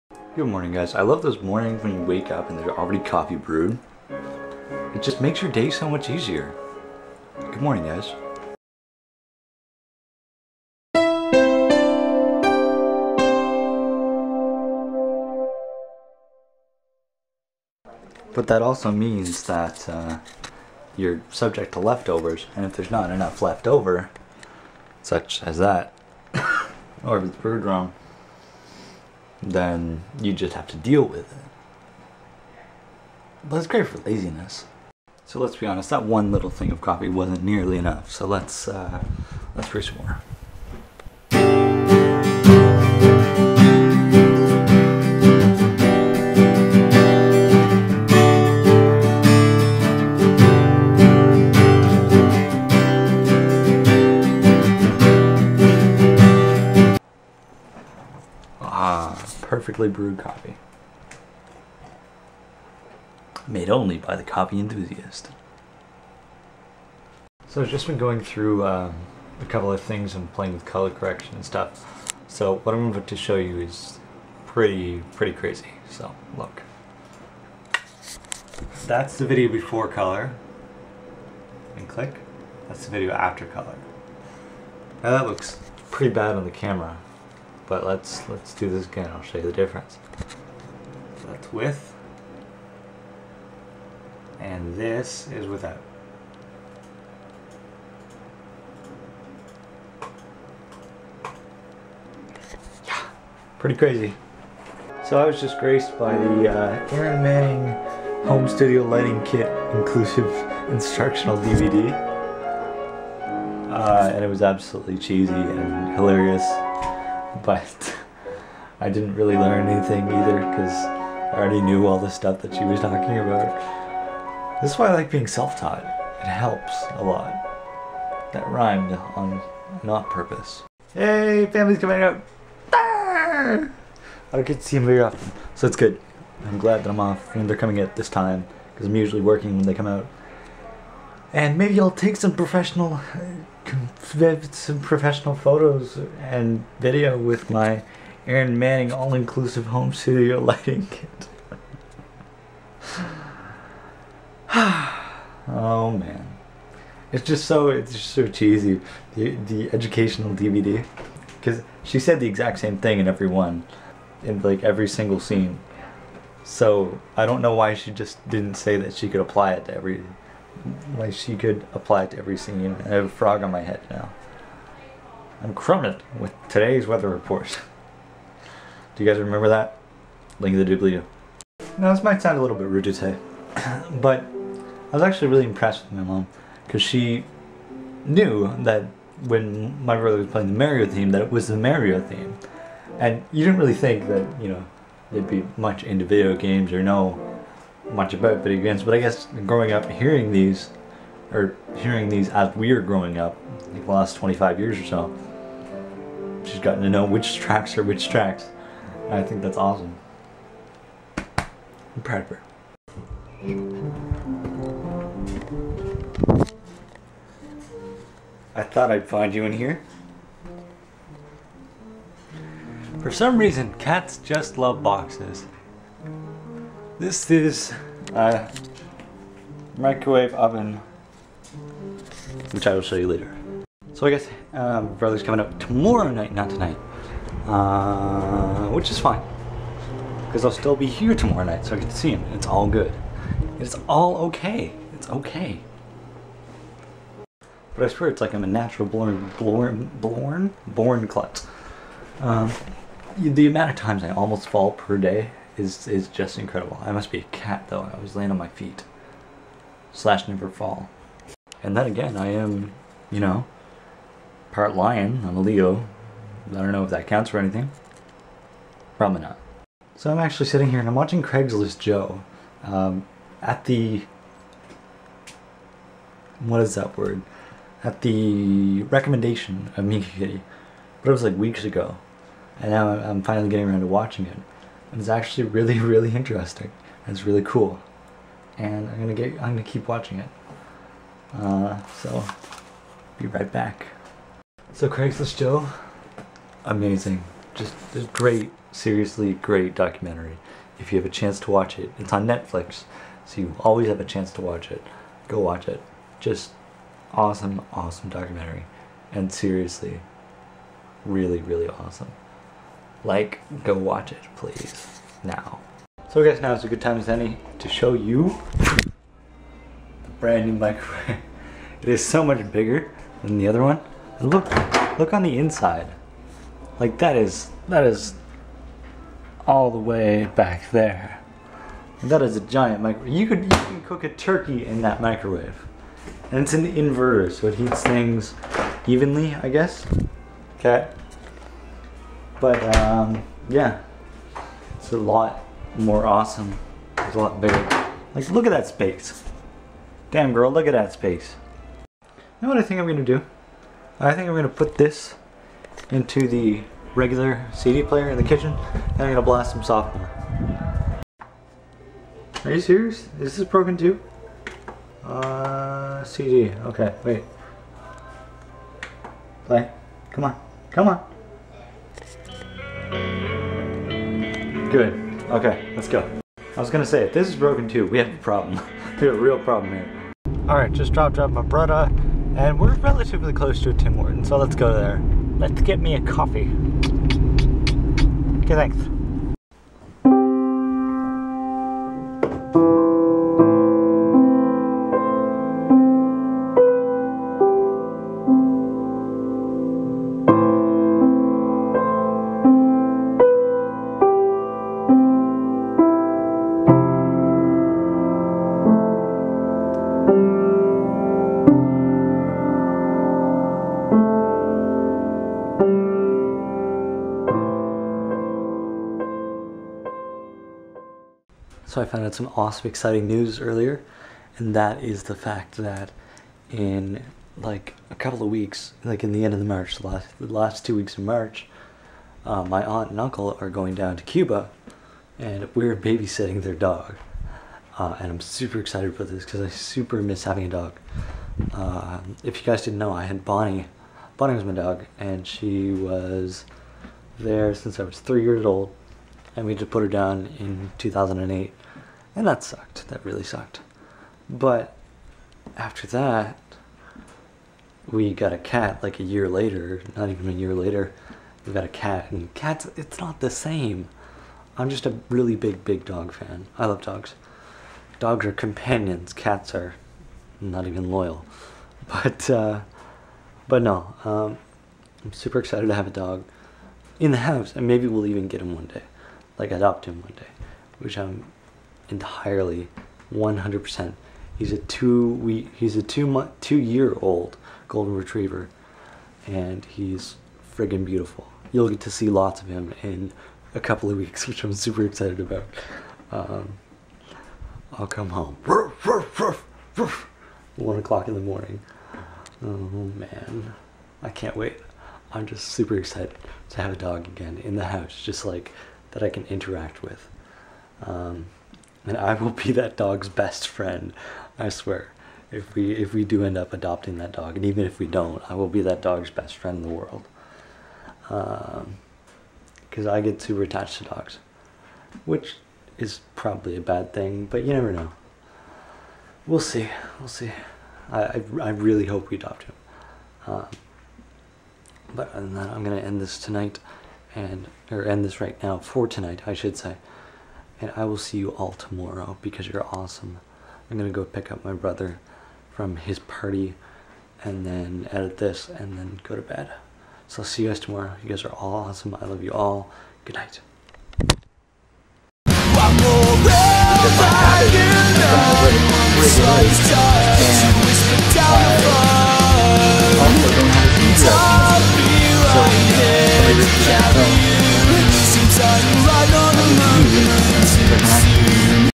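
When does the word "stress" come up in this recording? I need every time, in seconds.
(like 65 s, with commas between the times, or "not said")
not said.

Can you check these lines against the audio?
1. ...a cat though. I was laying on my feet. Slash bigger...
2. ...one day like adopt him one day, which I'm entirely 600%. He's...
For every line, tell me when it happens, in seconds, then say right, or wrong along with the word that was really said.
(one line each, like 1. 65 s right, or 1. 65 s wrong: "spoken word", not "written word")
1. 257 s wrong: "never", not "bigger"
2. 478 s wrong: "100", not "600".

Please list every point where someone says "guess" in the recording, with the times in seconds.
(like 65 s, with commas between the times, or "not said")
198 s, 234 s, 316 s, 339 s.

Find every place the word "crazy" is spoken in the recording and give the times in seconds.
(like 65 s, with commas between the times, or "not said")
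75 s, 103 s.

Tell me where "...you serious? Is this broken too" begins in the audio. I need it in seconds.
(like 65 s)
362 s.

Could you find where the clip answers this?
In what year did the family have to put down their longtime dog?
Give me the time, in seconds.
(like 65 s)
450 s.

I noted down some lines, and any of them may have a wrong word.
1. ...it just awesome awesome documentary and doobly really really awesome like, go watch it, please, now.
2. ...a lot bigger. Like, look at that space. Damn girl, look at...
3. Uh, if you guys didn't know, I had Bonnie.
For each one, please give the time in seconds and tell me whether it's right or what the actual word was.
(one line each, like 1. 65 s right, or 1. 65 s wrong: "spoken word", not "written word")
1. 305 s wrong: "seriously", not "doobly"
2. 347 s right
3. 441 s right.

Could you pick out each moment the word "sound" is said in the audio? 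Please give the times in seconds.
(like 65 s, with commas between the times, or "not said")
182 s.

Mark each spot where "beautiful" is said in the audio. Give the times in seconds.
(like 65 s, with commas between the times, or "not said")
490 s.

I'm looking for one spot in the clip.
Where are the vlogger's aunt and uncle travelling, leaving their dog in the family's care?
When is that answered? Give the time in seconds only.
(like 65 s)
434 s.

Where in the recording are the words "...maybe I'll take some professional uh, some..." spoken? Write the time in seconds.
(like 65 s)
141 s.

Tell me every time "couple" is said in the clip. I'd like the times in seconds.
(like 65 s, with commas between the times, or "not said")
69 s, 427 s, 493 s.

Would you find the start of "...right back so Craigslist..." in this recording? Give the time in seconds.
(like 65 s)
293 s.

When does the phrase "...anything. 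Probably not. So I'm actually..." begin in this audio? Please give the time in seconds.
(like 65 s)
267 s.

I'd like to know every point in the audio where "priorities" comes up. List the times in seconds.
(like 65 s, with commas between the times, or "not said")
not said.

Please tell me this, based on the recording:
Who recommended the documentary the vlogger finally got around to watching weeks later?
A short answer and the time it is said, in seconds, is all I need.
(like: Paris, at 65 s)
Miki Kitty, at 279 s.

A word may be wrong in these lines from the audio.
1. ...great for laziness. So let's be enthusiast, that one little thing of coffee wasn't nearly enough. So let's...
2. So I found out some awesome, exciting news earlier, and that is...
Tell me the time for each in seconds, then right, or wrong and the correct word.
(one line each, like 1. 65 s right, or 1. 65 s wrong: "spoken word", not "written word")
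1. 33 s wrong: "honest", not "enthusiast"
2. 421 s right.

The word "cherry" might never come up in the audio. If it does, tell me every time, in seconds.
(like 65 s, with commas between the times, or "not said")
not said.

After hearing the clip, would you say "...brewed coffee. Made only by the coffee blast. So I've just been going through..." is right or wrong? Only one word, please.
wrong.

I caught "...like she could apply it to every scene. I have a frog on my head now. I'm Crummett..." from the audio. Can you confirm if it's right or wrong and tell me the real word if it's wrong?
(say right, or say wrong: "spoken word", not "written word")
right.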